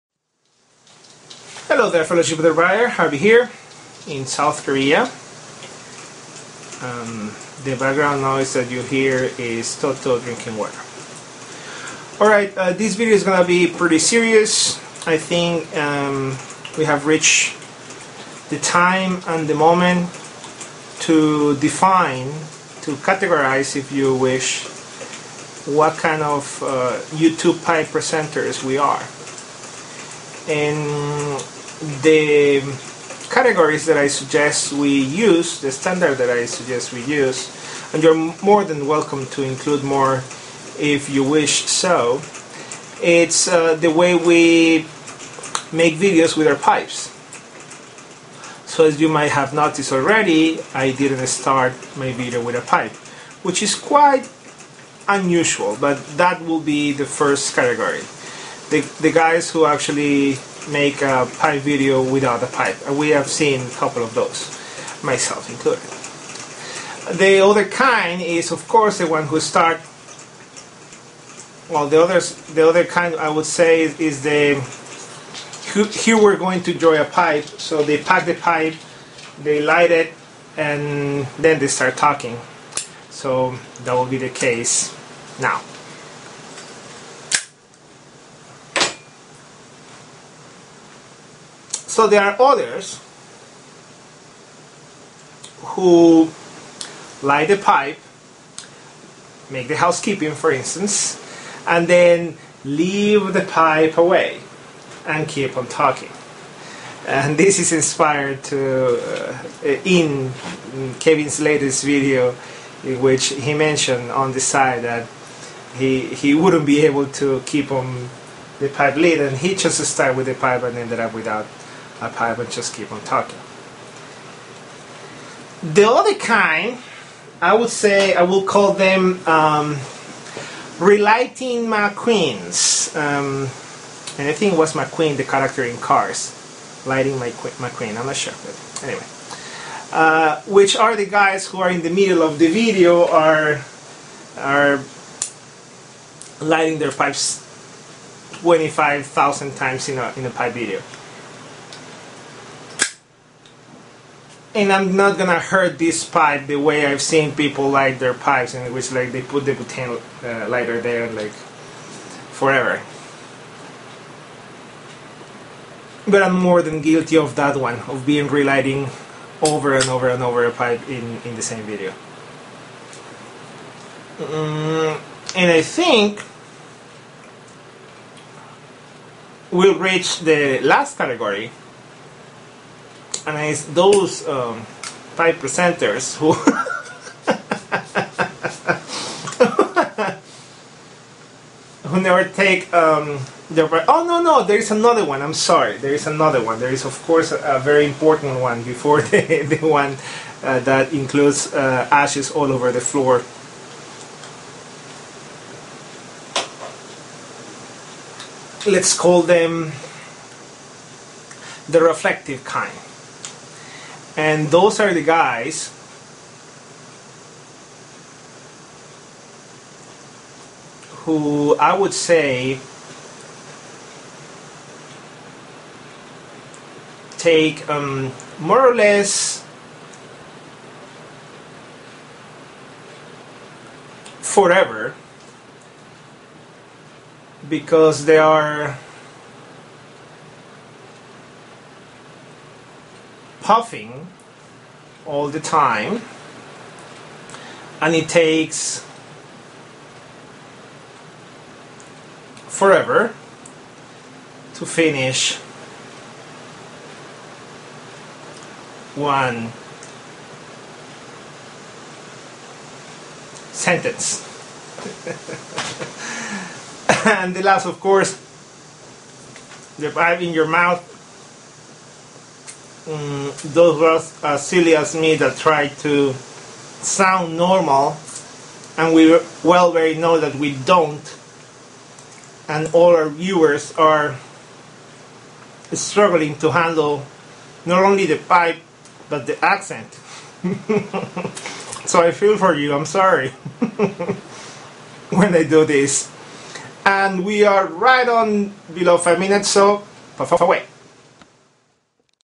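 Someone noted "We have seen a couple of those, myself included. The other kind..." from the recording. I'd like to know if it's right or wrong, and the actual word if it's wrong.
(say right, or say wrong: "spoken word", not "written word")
right.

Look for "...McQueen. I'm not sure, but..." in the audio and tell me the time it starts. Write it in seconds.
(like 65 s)
137 s.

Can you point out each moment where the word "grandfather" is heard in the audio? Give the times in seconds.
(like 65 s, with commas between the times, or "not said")
not said.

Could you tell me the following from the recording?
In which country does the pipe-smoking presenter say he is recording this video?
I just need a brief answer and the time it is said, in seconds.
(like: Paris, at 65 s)
South Korea, at 4 s.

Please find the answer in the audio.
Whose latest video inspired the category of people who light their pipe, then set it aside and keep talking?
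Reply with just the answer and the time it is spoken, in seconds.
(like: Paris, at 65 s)
Kevin, at 111 s.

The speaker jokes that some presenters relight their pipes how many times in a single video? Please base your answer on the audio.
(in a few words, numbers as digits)
25,000.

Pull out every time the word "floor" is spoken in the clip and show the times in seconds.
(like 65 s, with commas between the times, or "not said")
202 s.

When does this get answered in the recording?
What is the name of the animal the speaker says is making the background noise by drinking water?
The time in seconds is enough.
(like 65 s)
9 s.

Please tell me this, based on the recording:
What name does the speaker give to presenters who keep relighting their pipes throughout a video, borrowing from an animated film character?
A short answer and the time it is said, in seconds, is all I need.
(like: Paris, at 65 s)
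Relighting McQueens, at 130 s.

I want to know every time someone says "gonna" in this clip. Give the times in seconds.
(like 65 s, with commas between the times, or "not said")
13 s, 155 s.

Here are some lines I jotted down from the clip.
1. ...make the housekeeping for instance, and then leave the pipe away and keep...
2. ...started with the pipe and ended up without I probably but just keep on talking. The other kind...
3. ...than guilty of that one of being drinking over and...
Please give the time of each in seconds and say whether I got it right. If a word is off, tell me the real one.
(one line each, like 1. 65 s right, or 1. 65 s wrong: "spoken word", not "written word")
1. 99 s right
2. 119 s right
3. 166 s wrong: "relighting", not "drinking".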